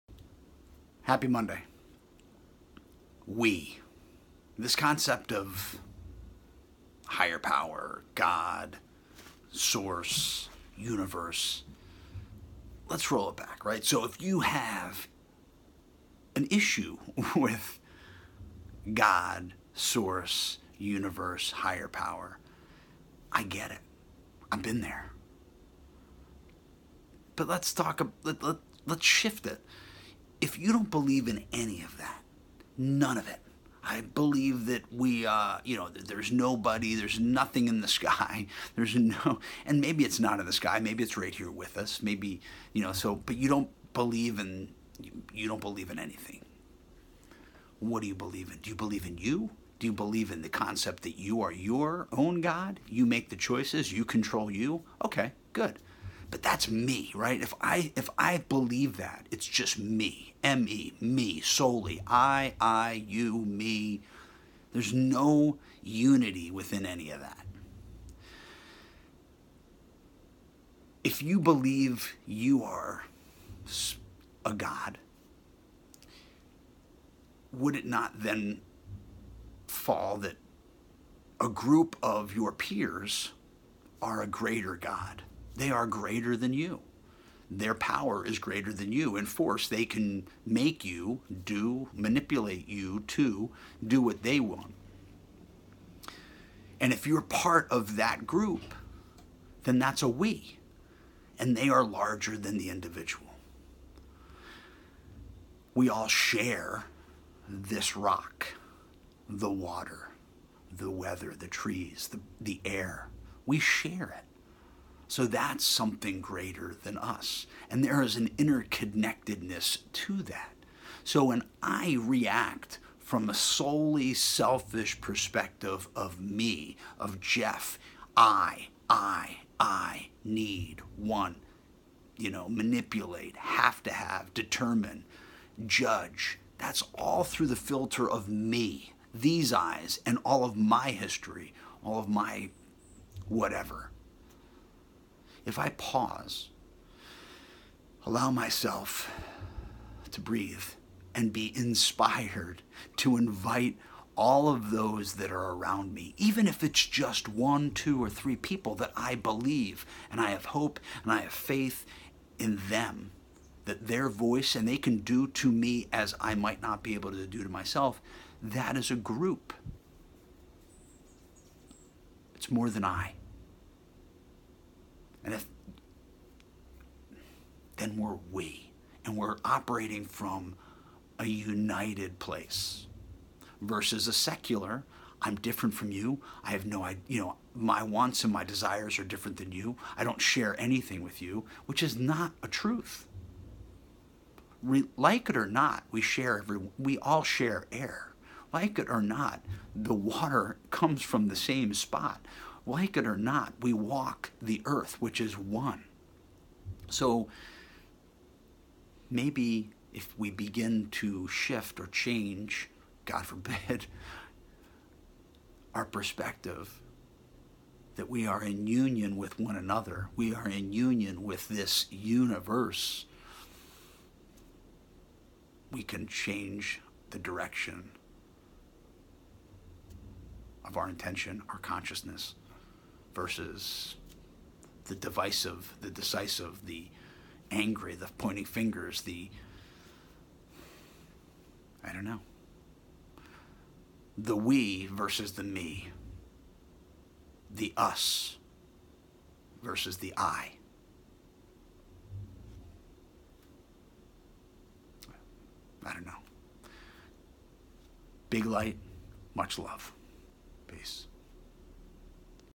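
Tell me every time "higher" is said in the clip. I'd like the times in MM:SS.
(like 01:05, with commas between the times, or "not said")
00:07, 00:21.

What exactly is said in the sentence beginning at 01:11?
If you believe you are a God, would it not then fall that a group of your peers are a greater God?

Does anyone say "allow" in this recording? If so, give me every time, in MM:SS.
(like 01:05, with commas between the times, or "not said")
02:28.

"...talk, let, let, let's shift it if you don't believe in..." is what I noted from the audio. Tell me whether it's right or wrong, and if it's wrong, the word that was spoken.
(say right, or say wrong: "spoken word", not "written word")
right.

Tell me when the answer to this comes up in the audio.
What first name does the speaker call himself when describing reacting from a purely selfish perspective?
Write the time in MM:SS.
02:07.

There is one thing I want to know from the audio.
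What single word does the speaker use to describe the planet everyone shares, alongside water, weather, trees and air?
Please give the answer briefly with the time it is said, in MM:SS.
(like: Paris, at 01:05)
rock, at 01:47.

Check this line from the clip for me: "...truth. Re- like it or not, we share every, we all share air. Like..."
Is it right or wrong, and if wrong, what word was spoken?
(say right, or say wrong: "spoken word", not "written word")
right.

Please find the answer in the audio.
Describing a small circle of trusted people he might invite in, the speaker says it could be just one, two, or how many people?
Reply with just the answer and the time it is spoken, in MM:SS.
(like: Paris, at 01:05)
3, at 02:38.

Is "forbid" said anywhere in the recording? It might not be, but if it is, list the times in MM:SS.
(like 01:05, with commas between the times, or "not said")
03:33.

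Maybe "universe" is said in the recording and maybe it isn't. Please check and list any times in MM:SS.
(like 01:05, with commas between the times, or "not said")
00:10, 00:20, 03:41.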